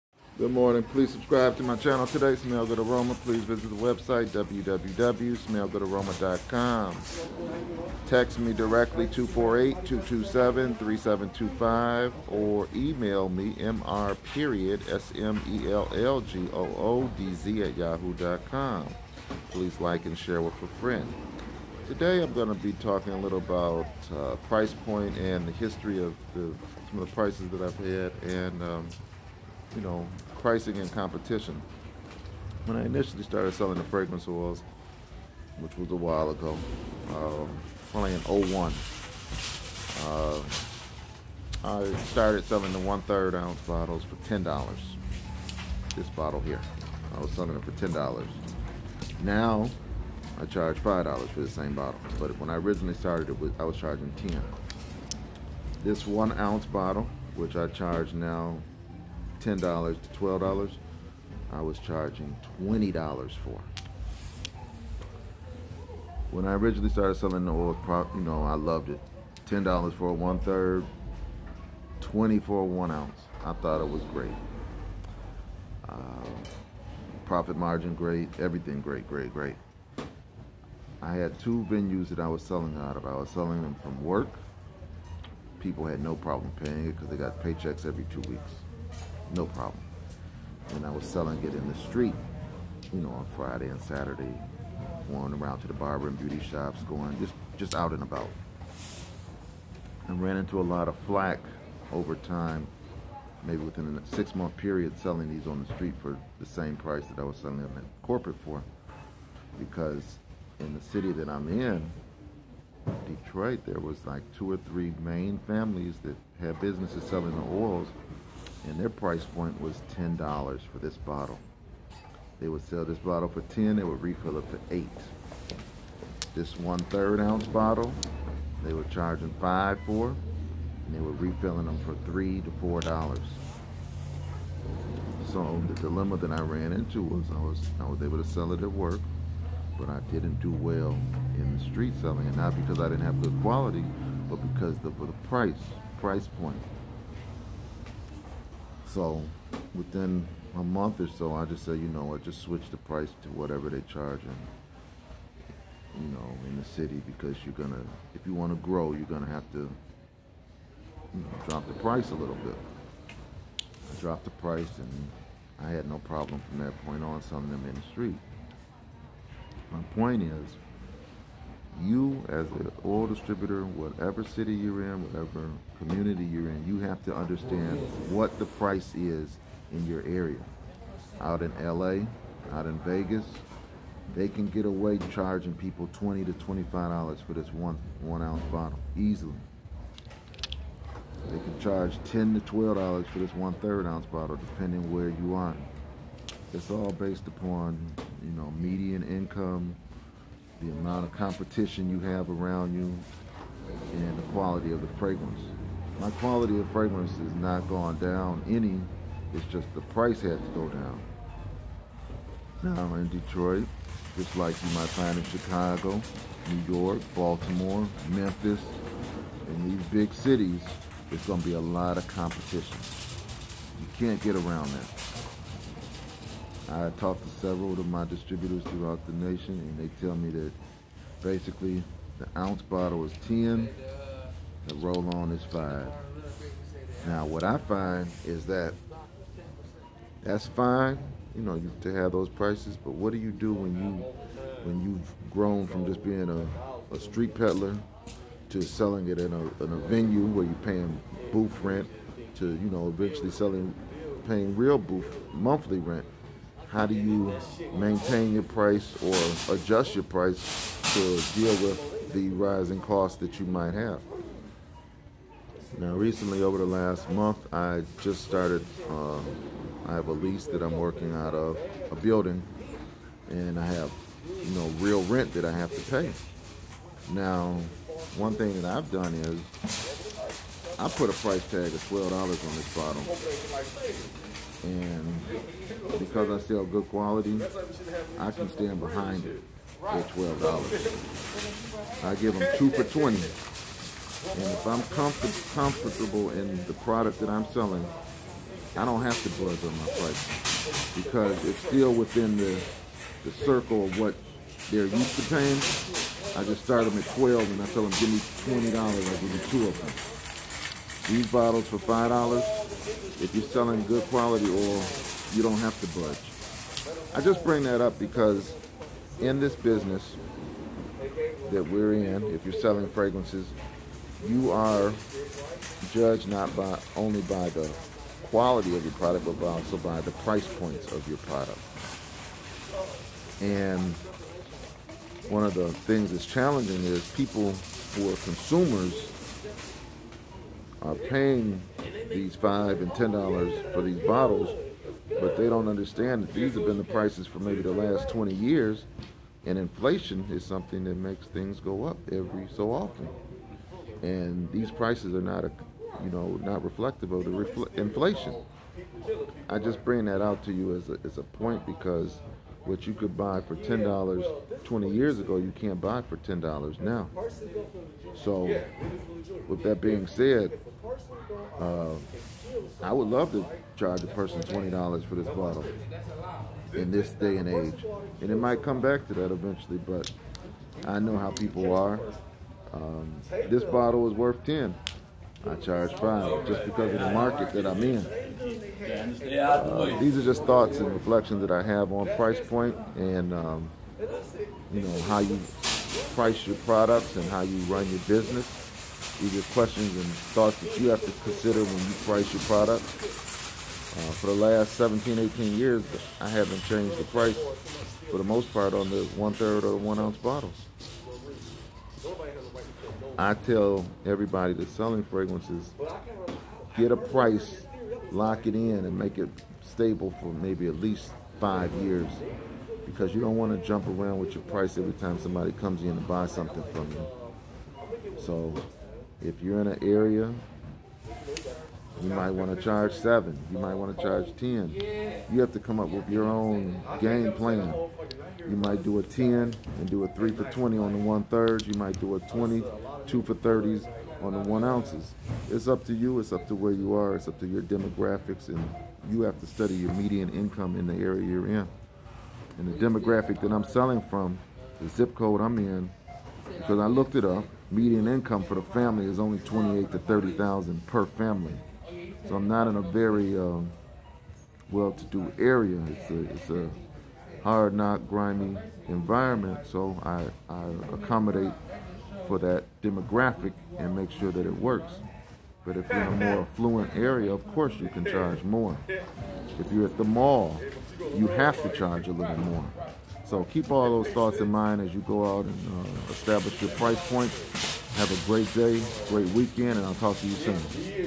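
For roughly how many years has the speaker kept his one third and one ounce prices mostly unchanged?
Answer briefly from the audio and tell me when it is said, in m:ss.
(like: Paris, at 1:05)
17 to 18 years, at 6:44.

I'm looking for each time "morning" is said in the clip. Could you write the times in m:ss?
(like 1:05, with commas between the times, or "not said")
0:00.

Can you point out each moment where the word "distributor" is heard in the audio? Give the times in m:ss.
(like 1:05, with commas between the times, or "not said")
2:53, 3:48.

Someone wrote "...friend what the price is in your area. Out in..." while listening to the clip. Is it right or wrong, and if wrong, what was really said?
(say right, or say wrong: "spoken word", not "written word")
wrong: "understand", not "friend".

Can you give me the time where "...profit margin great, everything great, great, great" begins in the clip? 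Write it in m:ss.
1:17.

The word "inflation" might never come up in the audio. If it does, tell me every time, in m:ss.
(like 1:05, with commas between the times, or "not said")
5:49, 5:57.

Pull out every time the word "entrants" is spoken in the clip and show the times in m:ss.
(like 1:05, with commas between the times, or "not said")
not said.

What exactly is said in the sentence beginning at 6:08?
So, with that being said, uh, I would love to charge a person $20 for this bottle in this day and age.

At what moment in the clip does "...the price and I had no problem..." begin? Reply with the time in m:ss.
2:44.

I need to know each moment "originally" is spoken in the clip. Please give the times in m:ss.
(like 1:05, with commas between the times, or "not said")
0:52, 1:06.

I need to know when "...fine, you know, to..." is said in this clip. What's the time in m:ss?
4:00.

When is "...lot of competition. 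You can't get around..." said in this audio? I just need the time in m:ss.
3:41.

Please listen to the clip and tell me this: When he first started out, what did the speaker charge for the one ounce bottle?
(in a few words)
$20.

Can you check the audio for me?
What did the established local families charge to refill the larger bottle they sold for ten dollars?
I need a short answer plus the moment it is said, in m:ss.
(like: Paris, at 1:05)
$8, at 2:04.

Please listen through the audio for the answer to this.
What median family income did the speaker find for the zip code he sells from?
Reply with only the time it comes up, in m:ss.
7:39.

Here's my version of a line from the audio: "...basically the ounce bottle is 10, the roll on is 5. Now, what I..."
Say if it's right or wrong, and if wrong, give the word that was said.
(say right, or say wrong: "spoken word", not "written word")
right.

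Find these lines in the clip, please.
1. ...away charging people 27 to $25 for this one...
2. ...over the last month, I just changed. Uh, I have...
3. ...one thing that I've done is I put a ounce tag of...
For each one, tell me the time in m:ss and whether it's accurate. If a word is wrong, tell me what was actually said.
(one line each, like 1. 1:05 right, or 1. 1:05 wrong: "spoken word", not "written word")
1. 3:04 wrong: "20", not "27"
2. 4:26 wrong: "started", not "changed"
3. 4:38 wrong: "price", not "ounce".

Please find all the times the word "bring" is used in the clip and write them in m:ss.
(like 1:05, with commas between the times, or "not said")
5:17, 5:59.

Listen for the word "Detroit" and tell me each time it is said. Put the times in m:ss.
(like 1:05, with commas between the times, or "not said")
1:53, 3:33.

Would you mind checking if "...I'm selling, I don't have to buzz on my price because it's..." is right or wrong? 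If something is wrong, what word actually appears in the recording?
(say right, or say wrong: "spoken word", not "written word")
right.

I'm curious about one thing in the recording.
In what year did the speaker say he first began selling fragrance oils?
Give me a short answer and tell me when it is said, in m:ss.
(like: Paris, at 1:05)
2001, at 0:38.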